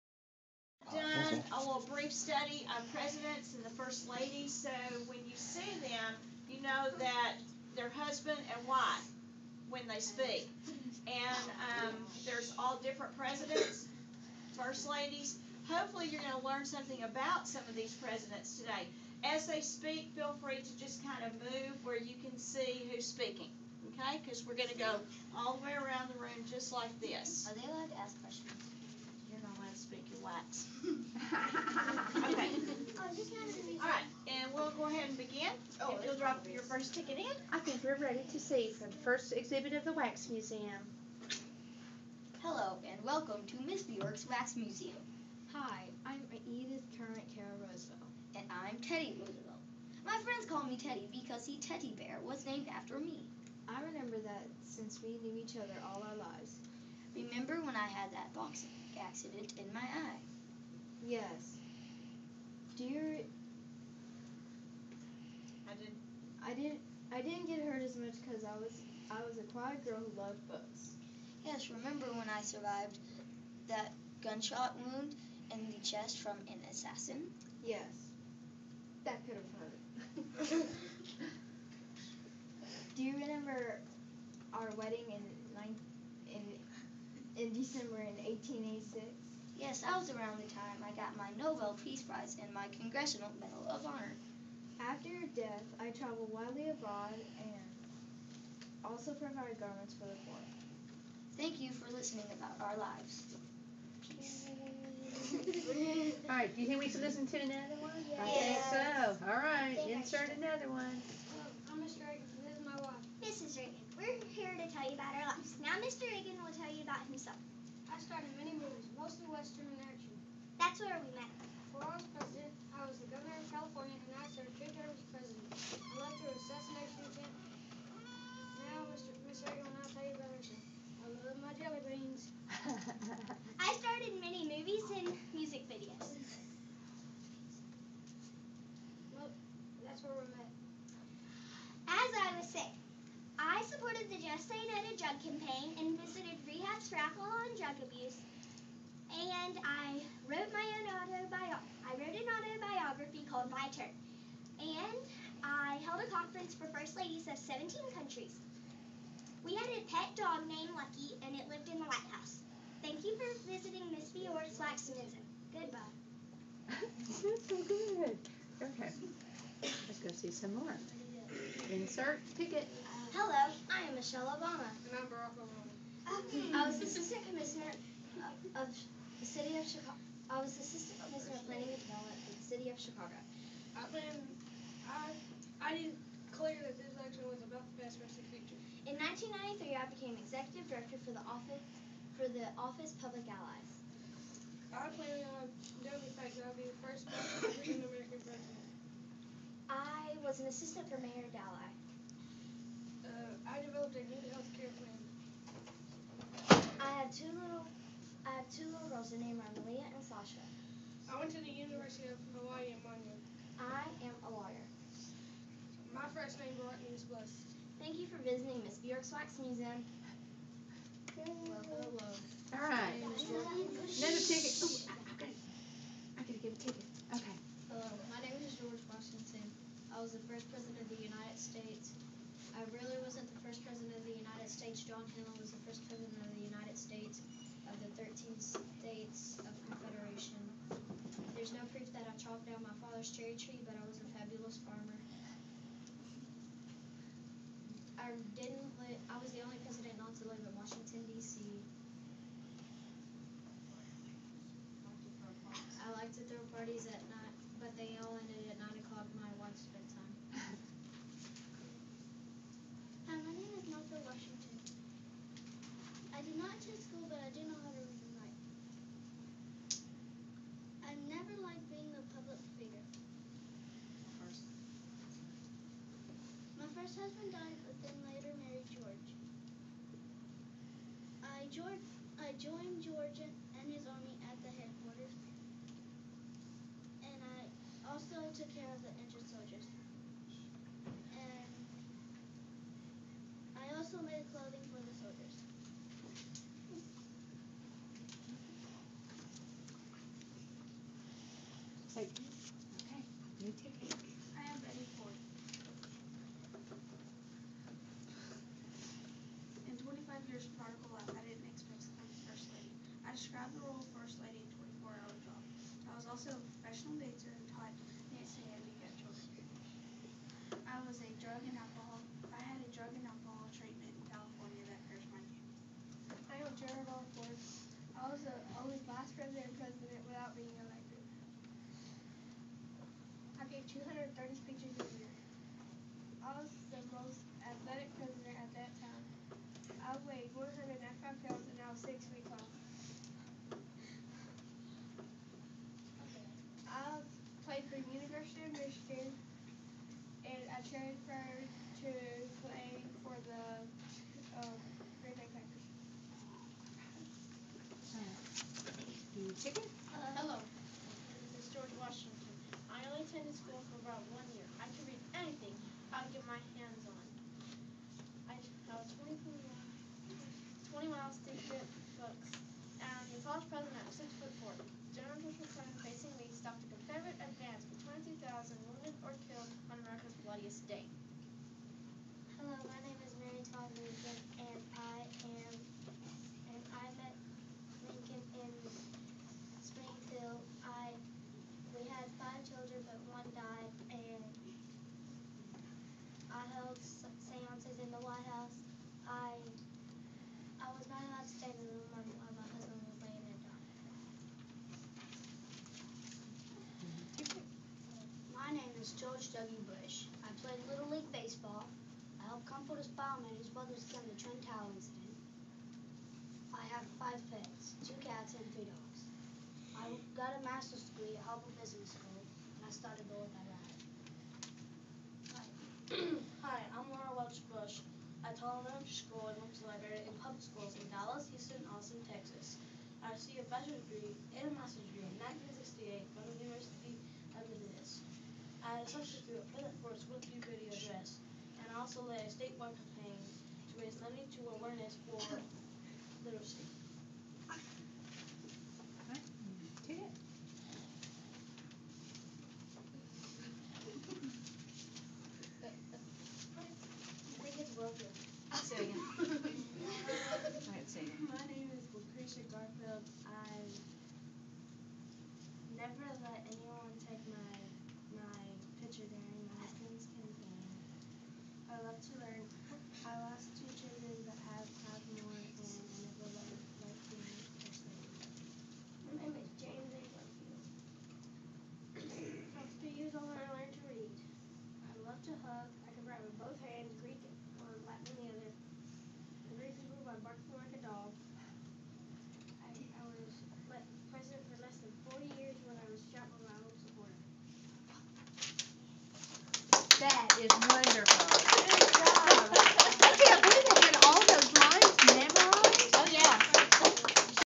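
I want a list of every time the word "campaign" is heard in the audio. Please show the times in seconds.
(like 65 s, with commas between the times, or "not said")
145 s, 442 s.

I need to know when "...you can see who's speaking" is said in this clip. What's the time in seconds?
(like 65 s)
21 s.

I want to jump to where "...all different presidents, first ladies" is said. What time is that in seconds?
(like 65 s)
12 s.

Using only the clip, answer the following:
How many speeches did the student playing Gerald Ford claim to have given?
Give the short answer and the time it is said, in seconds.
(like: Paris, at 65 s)
230, at 333 s.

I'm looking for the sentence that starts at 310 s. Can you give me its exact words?
of Pearson article I didn't expect to become First Lady.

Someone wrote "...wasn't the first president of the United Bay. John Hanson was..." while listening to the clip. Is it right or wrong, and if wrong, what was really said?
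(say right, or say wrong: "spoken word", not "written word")
wrong: "States", not "Bay".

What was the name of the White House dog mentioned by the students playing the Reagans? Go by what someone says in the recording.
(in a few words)
Lucky.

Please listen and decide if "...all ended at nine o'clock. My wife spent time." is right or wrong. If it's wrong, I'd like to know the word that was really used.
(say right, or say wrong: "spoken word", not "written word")
right.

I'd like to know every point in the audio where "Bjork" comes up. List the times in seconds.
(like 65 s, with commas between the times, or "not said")
43 s, 164 s, 218 s.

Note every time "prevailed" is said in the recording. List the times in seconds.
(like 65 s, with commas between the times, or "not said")
not said.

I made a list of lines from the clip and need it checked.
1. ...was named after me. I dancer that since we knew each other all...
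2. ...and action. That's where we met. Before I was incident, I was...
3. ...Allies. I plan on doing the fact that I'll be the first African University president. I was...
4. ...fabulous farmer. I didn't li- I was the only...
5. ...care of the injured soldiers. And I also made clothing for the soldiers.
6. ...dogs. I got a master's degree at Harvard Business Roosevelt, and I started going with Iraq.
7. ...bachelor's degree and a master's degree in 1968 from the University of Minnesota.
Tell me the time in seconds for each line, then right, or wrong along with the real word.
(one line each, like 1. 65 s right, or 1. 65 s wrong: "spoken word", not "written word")
1. 52 s wrong: "remember", not "dancer"
2. 119 s wrong: "president", not "incident"
3. 193 s wrong: "American", not "University"
4. 244 s right
5. 288 s right
6. 418 s wrong: "School", not "Roosevelt"
7. 433 s right.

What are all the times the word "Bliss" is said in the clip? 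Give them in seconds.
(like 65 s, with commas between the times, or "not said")
217 s.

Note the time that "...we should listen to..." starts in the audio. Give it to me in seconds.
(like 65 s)
106 s.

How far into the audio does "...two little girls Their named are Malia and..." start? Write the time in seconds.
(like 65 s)
208 s.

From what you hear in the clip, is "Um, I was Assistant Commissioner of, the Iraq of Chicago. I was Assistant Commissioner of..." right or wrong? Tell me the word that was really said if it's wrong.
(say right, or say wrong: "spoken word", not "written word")
wrong: "City", not "Iraq".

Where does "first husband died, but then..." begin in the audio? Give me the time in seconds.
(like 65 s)
276 s.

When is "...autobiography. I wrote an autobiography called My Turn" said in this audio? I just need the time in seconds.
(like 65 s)
150 s.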